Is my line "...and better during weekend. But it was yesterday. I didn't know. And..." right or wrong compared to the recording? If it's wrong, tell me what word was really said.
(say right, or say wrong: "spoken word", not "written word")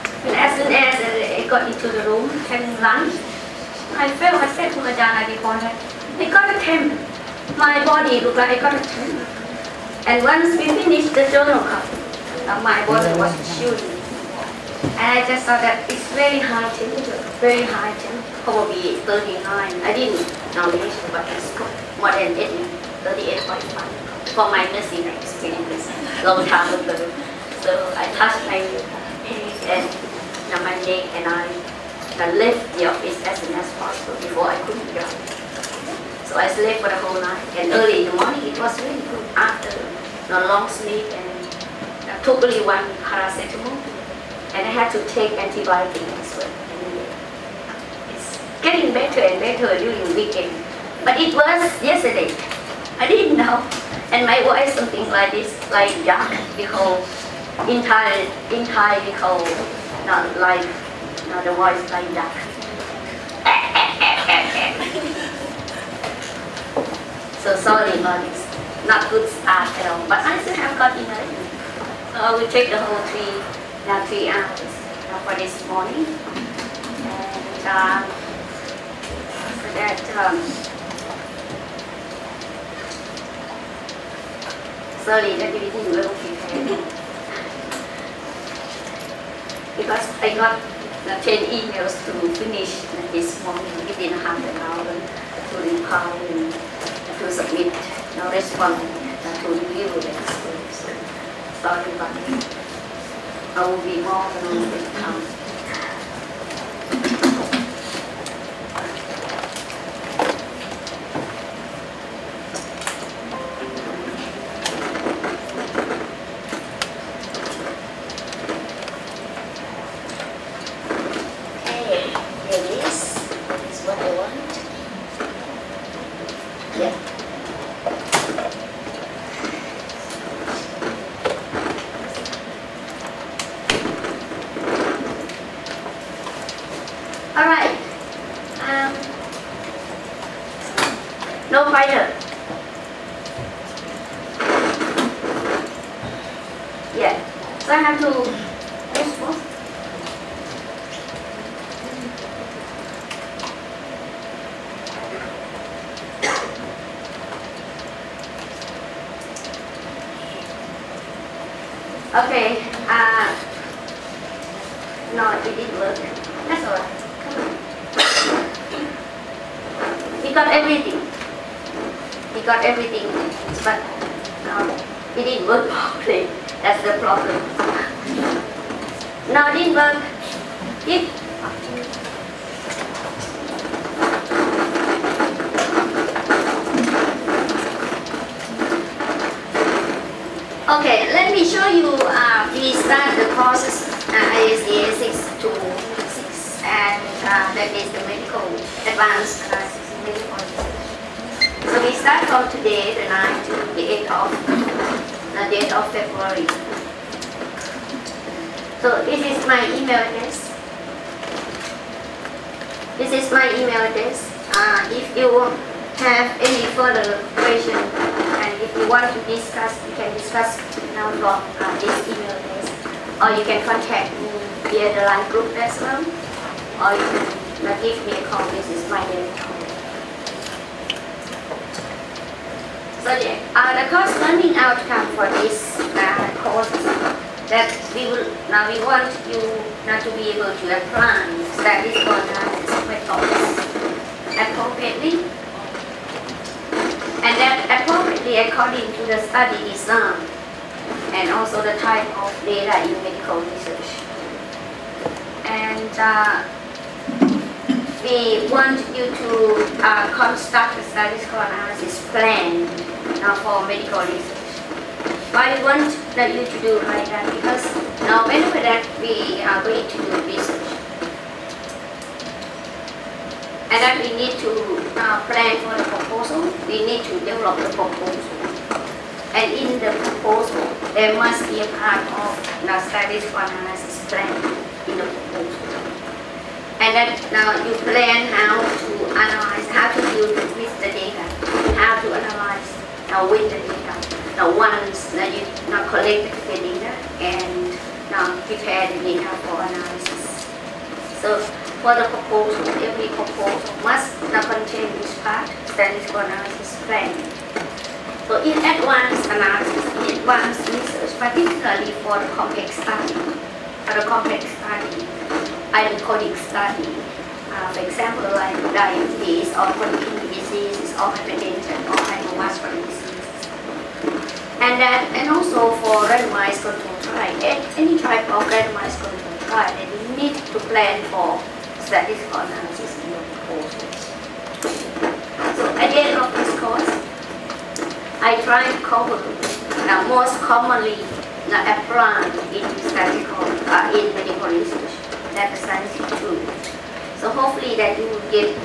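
right.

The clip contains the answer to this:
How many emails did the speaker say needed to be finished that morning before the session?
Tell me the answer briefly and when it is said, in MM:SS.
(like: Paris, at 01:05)
10, at 01:31.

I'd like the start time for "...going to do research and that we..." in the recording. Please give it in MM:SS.
04:29.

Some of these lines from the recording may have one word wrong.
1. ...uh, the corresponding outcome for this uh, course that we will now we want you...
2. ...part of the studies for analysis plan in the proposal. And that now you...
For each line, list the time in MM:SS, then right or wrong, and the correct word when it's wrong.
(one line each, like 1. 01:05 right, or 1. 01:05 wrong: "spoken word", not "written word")
1. 03:53 right
2. 04:41 right.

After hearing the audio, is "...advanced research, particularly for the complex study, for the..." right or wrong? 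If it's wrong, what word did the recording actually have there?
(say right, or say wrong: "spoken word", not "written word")
right.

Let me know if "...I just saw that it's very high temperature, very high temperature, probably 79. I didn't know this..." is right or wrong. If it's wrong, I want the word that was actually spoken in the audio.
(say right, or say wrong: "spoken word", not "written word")
wrong: "39", not "79".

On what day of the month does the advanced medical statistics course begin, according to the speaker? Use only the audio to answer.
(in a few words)
9th.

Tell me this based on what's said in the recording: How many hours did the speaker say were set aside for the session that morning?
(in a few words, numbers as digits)
3.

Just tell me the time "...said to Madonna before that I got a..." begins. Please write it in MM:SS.
00:04.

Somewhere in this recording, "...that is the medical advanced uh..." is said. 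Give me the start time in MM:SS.
03:17.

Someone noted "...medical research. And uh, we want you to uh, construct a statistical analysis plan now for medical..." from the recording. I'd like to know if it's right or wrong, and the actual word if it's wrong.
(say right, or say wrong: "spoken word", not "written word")
right.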